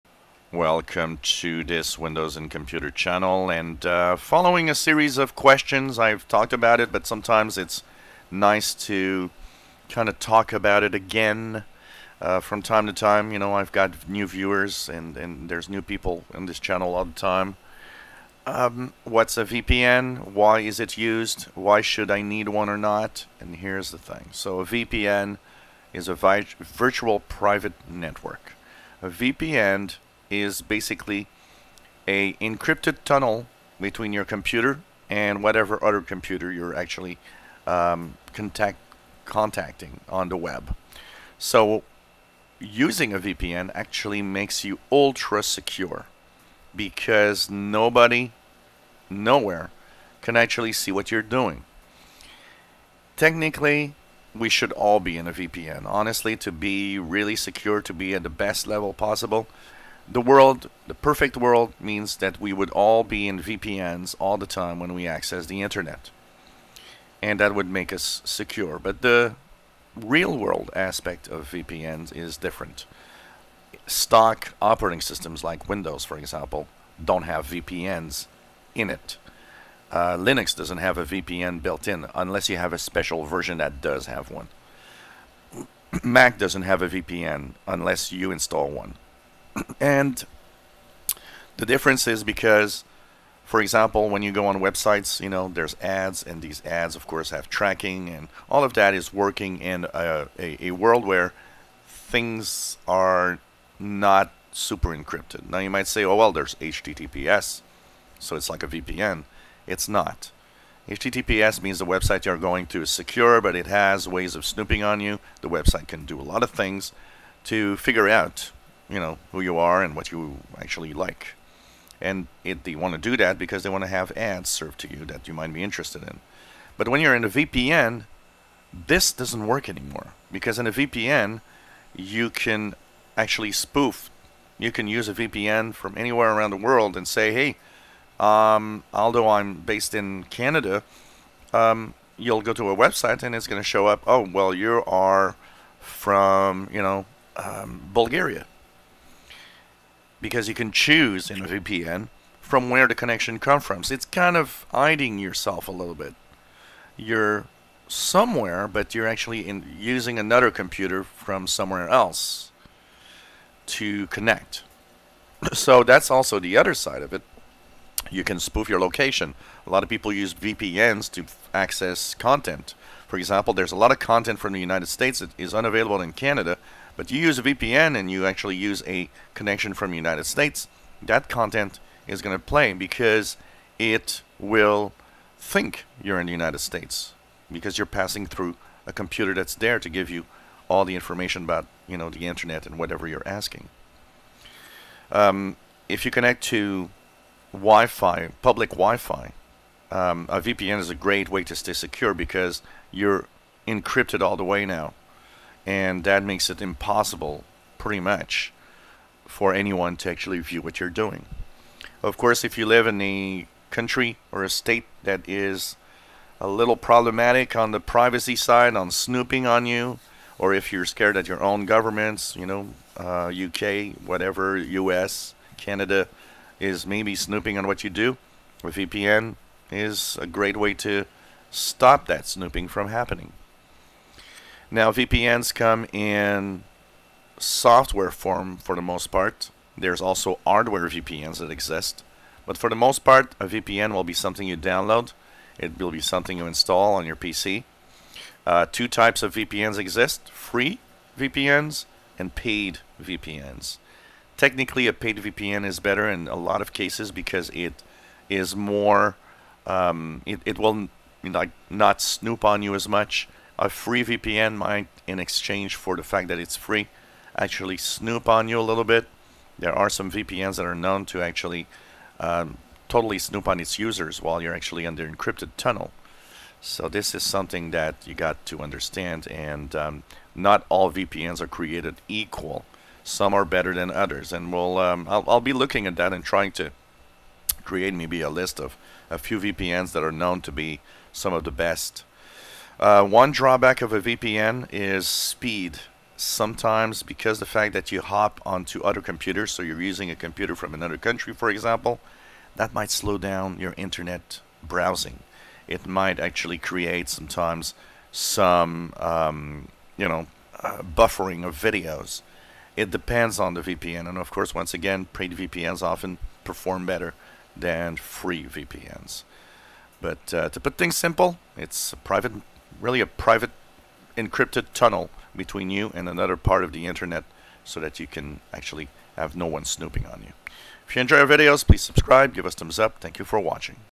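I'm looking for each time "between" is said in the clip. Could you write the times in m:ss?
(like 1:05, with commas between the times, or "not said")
0:33, 5:25.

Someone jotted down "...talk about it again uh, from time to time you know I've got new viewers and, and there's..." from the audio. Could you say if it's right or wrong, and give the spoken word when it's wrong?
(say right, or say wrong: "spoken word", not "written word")
right.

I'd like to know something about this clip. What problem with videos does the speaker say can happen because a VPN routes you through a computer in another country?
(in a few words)
Buffering.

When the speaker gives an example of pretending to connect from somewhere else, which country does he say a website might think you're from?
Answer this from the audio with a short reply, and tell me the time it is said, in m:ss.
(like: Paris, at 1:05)
Bulgaria, at 2:27.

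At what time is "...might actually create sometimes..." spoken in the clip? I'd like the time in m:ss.
5:05.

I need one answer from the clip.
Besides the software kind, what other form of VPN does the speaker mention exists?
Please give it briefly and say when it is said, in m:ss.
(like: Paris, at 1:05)
Hardware VPNs, at 4:00.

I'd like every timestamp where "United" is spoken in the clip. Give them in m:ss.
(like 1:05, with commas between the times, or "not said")
2:54, 2:59, 3:06.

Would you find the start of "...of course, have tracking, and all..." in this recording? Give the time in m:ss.
1:36.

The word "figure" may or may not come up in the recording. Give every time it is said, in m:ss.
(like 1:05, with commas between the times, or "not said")
1:57.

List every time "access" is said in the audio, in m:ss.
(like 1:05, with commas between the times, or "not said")
1:05, 2:51.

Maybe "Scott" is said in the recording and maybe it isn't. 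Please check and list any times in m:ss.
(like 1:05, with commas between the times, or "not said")
not said.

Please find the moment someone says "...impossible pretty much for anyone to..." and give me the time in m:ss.
3:26.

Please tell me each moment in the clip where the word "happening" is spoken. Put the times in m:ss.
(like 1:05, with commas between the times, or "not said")
3:52.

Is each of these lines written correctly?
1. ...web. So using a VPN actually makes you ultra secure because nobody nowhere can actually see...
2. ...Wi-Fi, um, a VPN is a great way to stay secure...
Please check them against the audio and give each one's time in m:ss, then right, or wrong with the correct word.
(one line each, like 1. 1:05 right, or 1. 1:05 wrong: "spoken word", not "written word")
1. 0:40 right
2. 3:18 right.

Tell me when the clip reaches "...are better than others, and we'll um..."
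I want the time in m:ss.
4:43.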